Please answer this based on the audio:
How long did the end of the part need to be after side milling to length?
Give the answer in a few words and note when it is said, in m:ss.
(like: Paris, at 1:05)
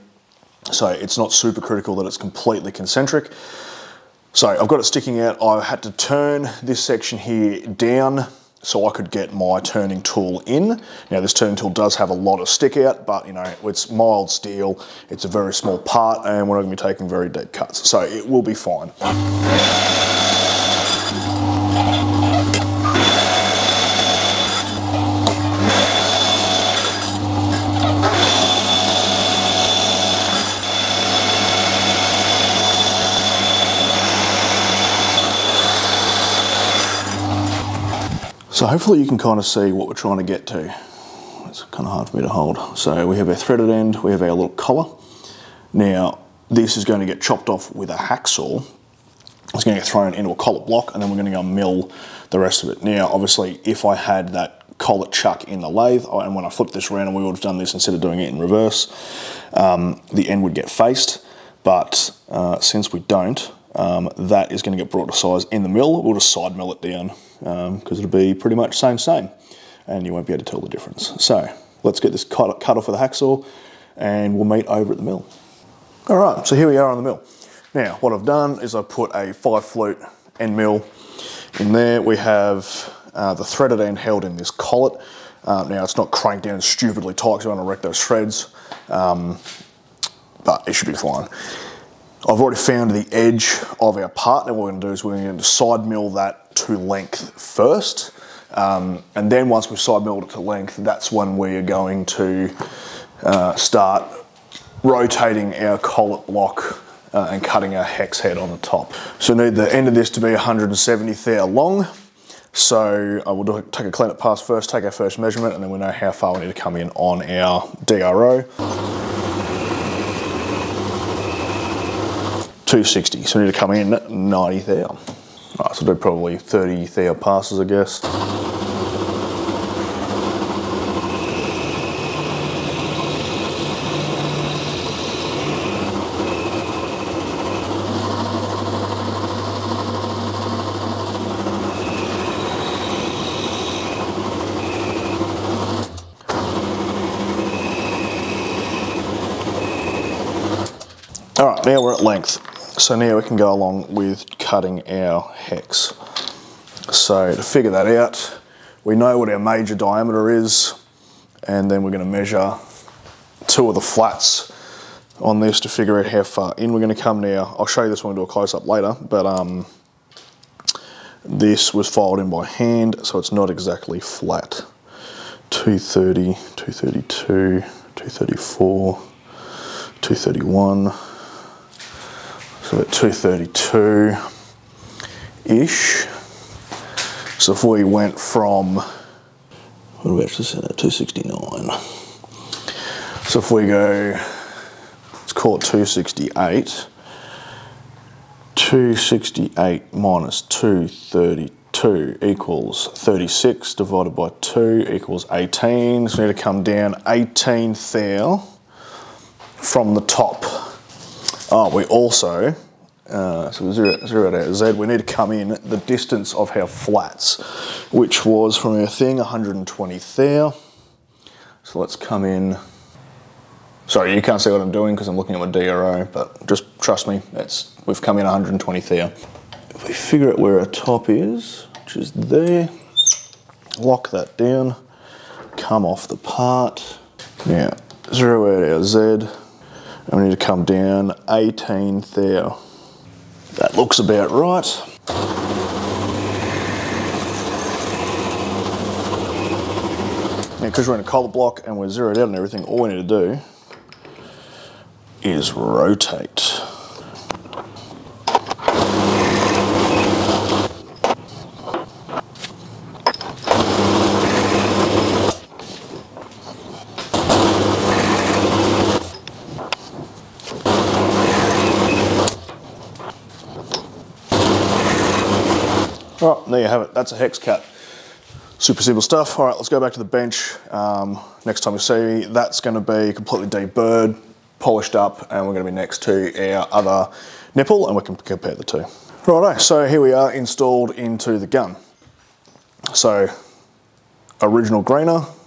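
170 thou, at 1:50.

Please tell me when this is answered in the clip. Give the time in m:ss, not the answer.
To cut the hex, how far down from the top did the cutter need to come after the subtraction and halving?
3:27.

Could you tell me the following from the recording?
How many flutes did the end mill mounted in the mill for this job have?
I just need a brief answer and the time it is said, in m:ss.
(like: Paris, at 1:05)
5 flute, at 1:19.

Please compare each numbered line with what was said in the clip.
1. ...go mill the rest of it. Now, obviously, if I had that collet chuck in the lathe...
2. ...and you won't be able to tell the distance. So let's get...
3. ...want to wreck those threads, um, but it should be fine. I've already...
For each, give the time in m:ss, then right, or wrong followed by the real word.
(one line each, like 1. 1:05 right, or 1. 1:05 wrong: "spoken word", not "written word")
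1. 0:51 right
2. 1:09 wrong: "difference", not "distance"
3. 1:27 right.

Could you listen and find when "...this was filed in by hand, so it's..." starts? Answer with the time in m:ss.
2:51.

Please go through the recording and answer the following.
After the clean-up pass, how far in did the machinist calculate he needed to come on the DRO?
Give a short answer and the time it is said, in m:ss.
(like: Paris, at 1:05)
90 thou, at 2:04.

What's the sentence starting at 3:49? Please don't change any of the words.
If we figure out where our top is, which is there, lock that down, come off the part.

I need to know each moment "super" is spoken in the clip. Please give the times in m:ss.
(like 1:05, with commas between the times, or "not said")
0:01, 4:38.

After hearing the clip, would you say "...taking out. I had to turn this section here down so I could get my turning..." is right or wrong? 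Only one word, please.
wrong.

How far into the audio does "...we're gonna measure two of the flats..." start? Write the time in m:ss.
2:41.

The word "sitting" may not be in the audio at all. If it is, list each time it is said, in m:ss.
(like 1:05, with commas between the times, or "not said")
not said.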